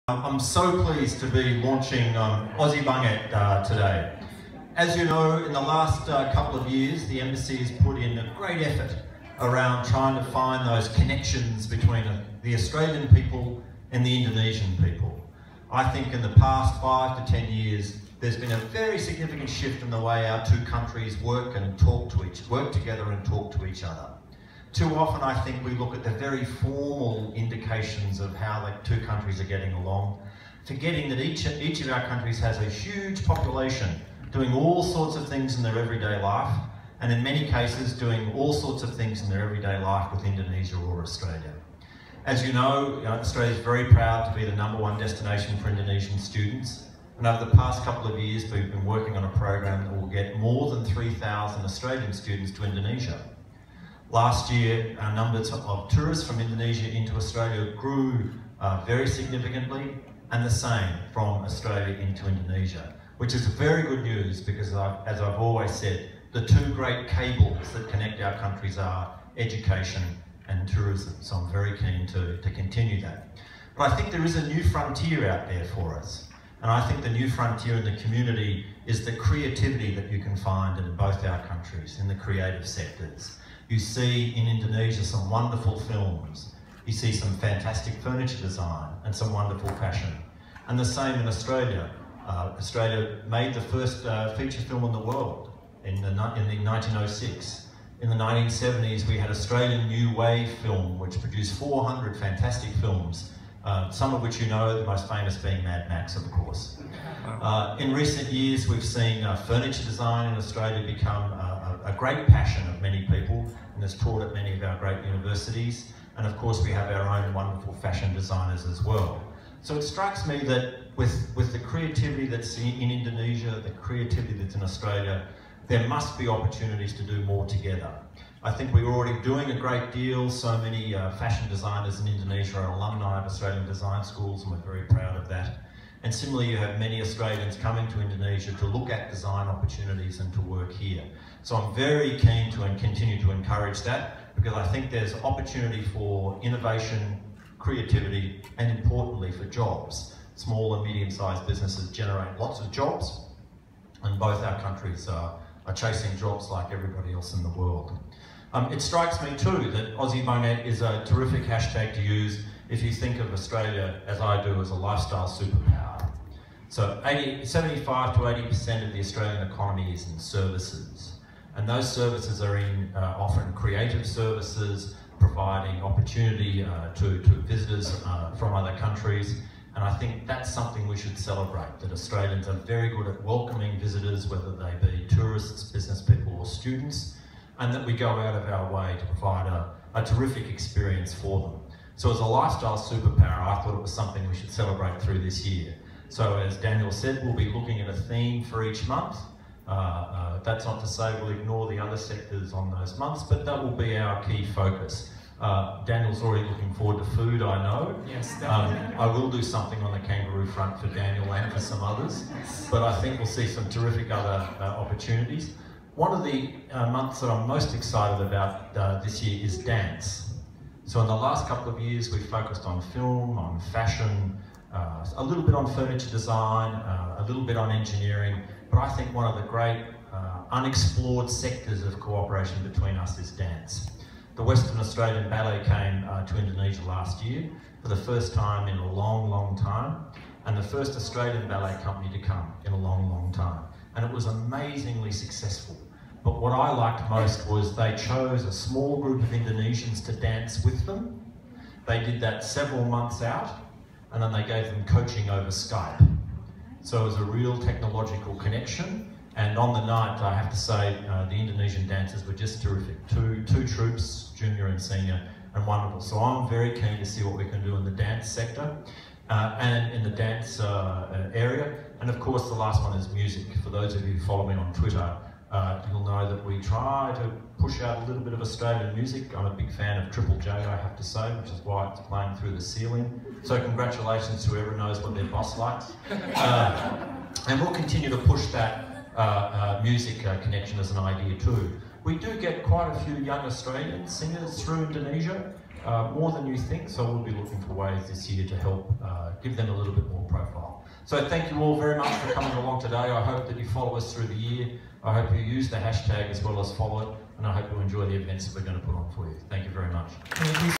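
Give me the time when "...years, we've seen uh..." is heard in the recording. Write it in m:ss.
1:48.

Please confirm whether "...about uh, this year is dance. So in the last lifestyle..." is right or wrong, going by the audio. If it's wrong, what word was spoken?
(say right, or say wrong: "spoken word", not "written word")
wrong: "couple", not "lifestyle".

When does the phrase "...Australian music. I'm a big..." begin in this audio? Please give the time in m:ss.
4:38.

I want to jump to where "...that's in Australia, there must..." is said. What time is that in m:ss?
2:04.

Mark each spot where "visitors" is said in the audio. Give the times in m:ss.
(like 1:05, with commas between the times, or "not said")
2:57, 3:03.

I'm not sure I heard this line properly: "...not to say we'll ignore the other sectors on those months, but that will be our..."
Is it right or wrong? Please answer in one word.
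right.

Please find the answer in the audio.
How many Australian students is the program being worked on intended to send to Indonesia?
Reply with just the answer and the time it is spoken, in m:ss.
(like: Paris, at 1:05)
3,000, at 0:50.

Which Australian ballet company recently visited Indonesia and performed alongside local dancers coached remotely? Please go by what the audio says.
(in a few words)
Western Australian Ballet.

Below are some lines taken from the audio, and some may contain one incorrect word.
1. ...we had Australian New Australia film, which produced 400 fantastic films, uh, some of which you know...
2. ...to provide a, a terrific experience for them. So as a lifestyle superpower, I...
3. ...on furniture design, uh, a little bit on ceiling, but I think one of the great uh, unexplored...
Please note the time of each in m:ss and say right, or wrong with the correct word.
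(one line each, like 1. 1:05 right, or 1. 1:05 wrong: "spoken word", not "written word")
1. 1:39 wrong: "Wave", not "Australia"
2. 3:08 right
3. 3:45 wrong: "engineering", not "ceiling".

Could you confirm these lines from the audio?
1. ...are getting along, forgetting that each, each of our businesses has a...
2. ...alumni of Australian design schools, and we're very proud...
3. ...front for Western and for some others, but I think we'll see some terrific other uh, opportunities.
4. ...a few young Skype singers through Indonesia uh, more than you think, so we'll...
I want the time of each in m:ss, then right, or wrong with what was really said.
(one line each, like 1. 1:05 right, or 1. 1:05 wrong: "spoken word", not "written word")
1. 0:29 wrong: "countries", not "businesses"
2. 2:12 right
3. 3:30 wrong: "Daniel", not "Western"
4. 4:52 wrong: "Australian", not "Skype".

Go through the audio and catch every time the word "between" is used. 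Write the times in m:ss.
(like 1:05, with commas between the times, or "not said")
0:11, 3:52.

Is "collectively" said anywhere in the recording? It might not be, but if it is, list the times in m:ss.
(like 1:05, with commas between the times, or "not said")
not said.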